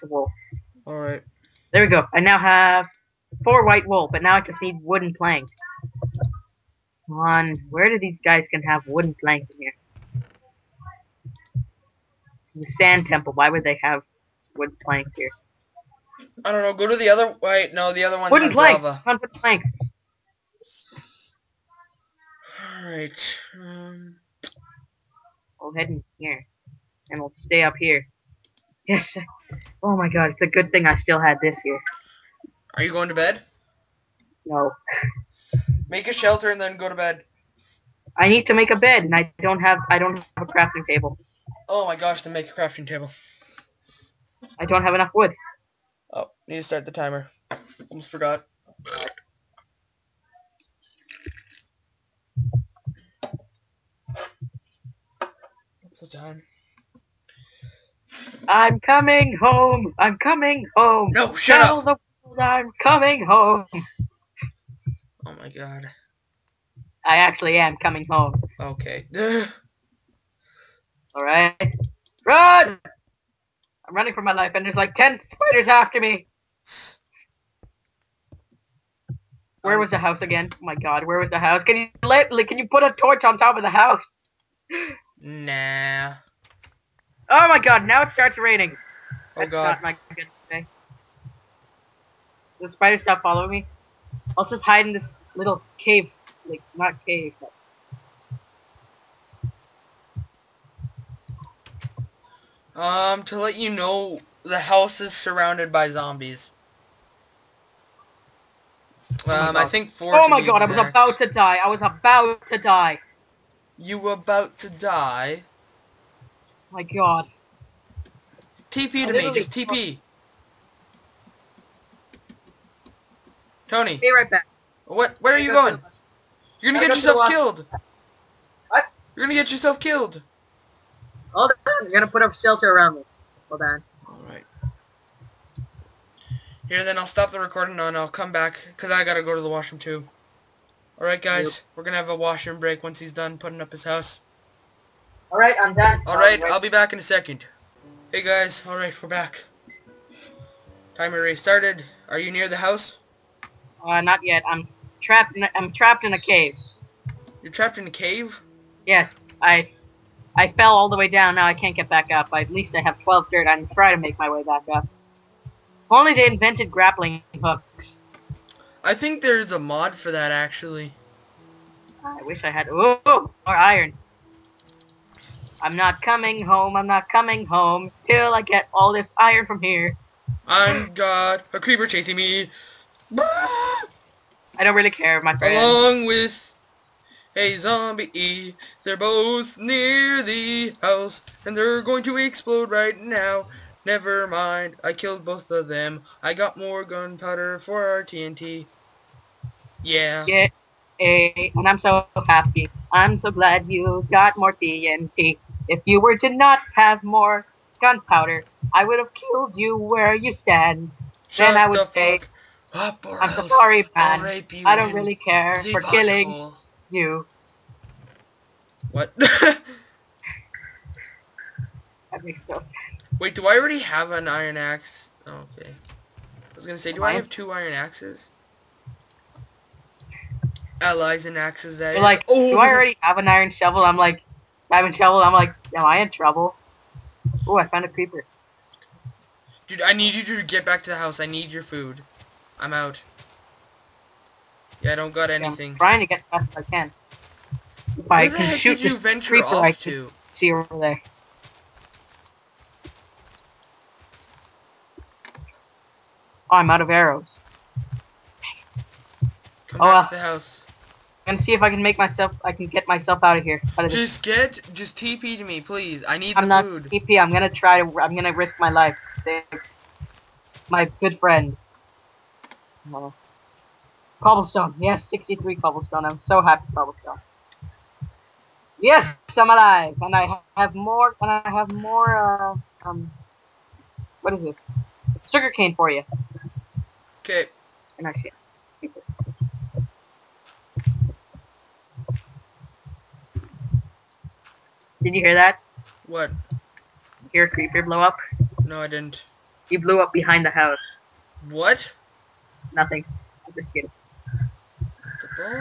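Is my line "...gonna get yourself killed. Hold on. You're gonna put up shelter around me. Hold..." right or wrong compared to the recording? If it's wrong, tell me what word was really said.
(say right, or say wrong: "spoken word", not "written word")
right.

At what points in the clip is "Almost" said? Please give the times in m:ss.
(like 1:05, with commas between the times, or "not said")
0:47.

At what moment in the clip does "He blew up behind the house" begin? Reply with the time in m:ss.
4:59.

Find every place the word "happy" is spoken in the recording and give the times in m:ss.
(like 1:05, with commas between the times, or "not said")
3:22, 4:36.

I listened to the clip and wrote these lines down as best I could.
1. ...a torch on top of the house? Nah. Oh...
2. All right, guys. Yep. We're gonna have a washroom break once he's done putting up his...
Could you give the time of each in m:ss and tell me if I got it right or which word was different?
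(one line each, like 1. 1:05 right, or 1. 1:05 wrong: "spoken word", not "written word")
1. 1:22 right
2. 2:20 right.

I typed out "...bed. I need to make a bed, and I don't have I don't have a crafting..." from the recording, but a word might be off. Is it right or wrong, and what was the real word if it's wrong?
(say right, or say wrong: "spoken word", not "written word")
right.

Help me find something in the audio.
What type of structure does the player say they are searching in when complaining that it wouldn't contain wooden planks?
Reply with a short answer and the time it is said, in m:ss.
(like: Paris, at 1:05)
Sand temple, at 0:12.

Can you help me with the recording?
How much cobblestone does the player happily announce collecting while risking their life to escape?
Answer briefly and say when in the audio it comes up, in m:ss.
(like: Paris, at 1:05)
63, at 4:35.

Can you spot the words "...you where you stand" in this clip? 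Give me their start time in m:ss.
3:29.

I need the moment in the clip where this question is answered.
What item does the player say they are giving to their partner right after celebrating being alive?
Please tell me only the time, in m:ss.
4:45.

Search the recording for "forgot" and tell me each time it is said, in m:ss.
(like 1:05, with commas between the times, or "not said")
0:48.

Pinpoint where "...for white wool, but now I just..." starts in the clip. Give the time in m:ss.
0:03.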